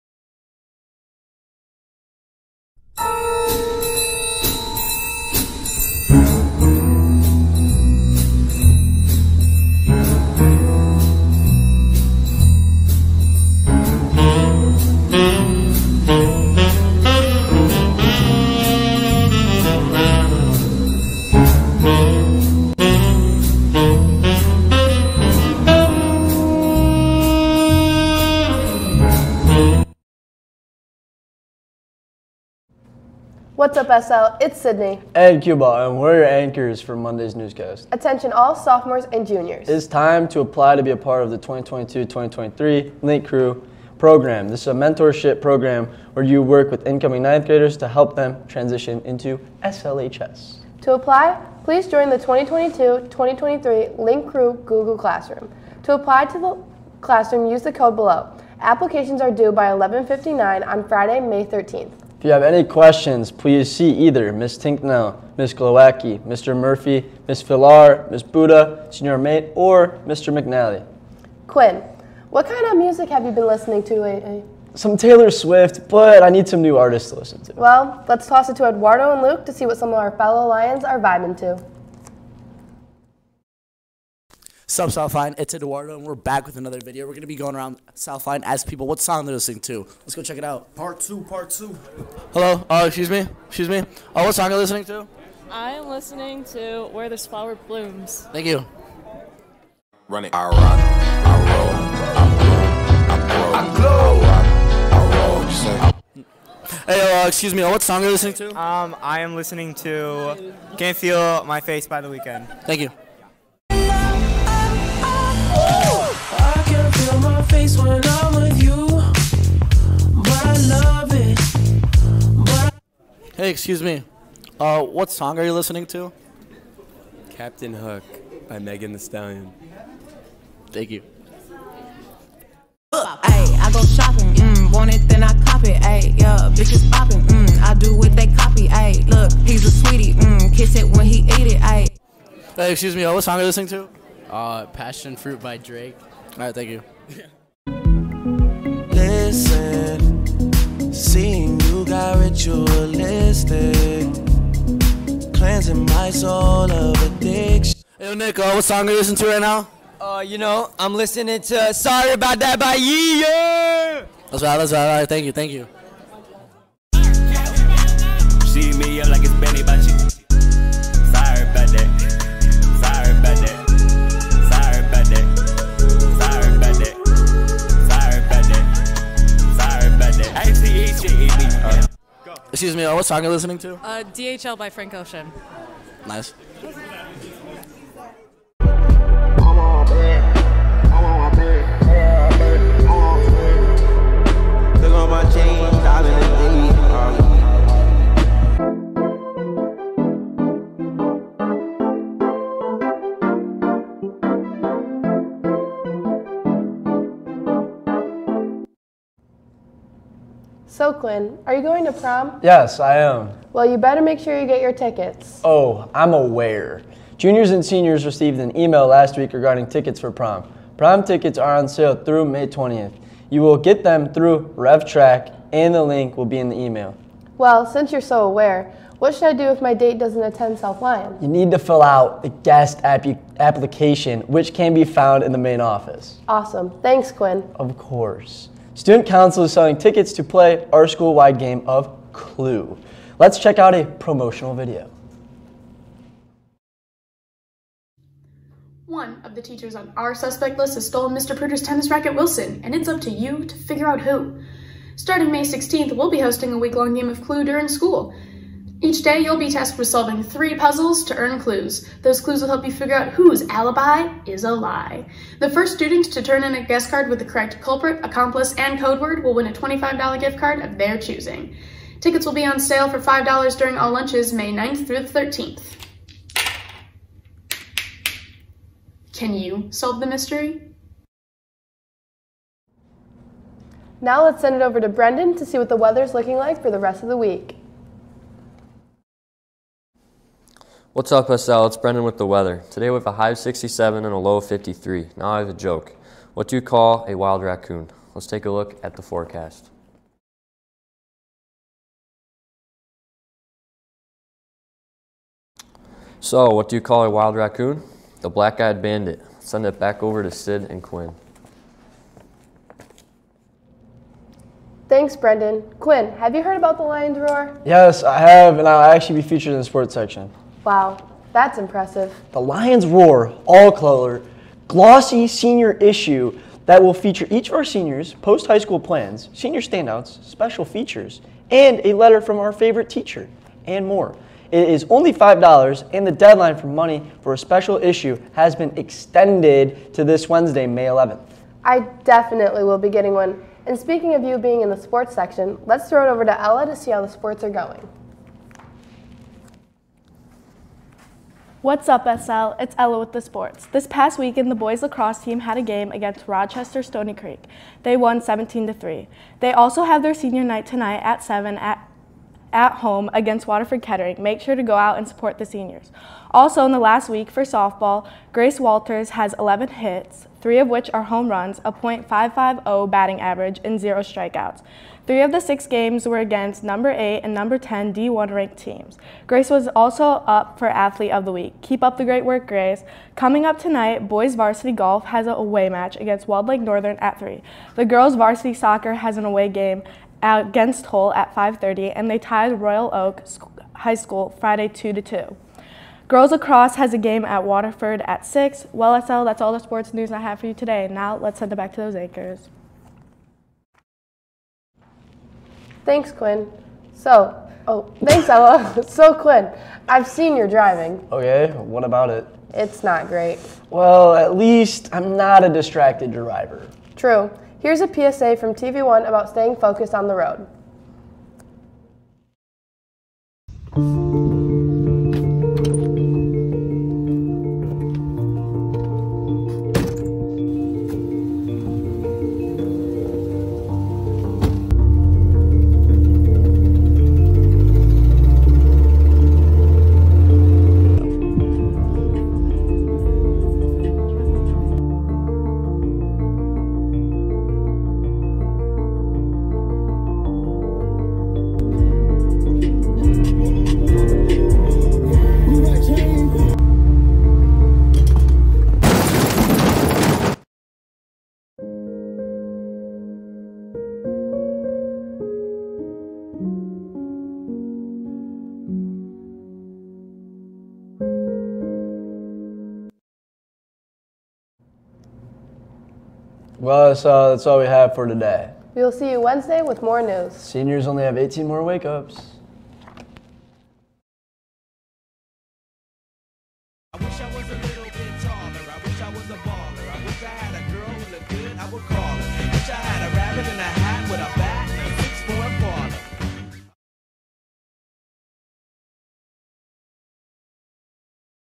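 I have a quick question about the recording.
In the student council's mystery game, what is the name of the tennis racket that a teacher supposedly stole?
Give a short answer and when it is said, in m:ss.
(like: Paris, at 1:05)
Wilson, at 4:12.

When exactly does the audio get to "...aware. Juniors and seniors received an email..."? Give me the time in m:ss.
3:36.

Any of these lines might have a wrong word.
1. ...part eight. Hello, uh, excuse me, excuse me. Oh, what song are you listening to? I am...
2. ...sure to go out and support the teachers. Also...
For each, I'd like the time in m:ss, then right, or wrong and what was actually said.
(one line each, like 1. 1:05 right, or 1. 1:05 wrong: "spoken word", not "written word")
1. 1:31 wrong: "two", not "eight"
2. 6:04 wrong: "seniors", not "teachers".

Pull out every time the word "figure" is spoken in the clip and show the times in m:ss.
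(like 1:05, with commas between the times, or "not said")
4:13, 4:22.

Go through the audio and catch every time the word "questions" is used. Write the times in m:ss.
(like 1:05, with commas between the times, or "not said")
1:02.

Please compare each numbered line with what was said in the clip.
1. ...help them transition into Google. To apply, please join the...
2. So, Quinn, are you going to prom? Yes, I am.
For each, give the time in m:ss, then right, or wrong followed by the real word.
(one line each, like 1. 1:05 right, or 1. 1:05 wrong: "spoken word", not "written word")
1. 0:47 wrong: "SLHS", not "Google"
2. 3:30 right.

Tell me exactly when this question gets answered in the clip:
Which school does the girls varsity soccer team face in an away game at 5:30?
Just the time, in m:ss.
6:30.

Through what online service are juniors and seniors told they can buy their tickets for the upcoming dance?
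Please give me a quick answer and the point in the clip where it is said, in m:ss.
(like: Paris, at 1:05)
RevTrak, at 3:44.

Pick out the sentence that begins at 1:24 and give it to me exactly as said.
Sub South Lyon, it's Eduardo, and we're back with another video.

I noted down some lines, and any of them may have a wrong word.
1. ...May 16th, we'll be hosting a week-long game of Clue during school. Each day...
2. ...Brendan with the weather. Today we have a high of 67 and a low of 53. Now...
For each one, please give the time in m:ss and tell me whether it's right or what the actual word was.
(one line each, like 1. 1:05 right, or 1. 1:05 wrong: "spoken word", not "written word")
1. 4:15 right
2. 4:51 right.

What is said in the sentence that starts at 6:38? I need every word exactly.
Well, SL, that's all the sports news I have for you today.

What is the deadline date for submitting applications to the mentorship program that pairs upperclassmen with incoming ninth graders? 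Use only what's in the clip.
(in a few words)
Friday, May 13th.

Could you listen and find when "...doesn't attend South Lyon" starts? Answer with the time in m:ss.
3:49.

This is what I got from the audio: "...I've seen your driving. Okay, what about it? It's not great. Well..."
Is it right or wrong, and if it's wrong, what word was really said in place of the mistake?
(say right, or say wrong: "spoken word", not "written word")
right.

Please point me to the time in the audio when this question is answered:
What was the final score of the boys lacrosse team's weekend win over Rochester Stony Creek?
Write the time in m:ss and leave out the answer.
5:58.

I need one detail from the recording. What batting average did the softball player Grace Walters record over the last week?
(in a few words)
.550.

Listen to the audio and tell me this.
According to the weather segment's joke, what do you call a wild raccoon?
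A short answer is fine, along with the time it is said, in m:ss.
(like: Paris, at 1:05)
The black-eyed bandit, at 5:08.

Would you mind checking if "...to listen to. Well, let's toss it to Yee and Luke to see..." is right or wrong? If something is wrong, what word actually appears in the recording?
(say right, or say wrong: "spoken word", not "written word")
wrong: "Eduardo", not "Yee".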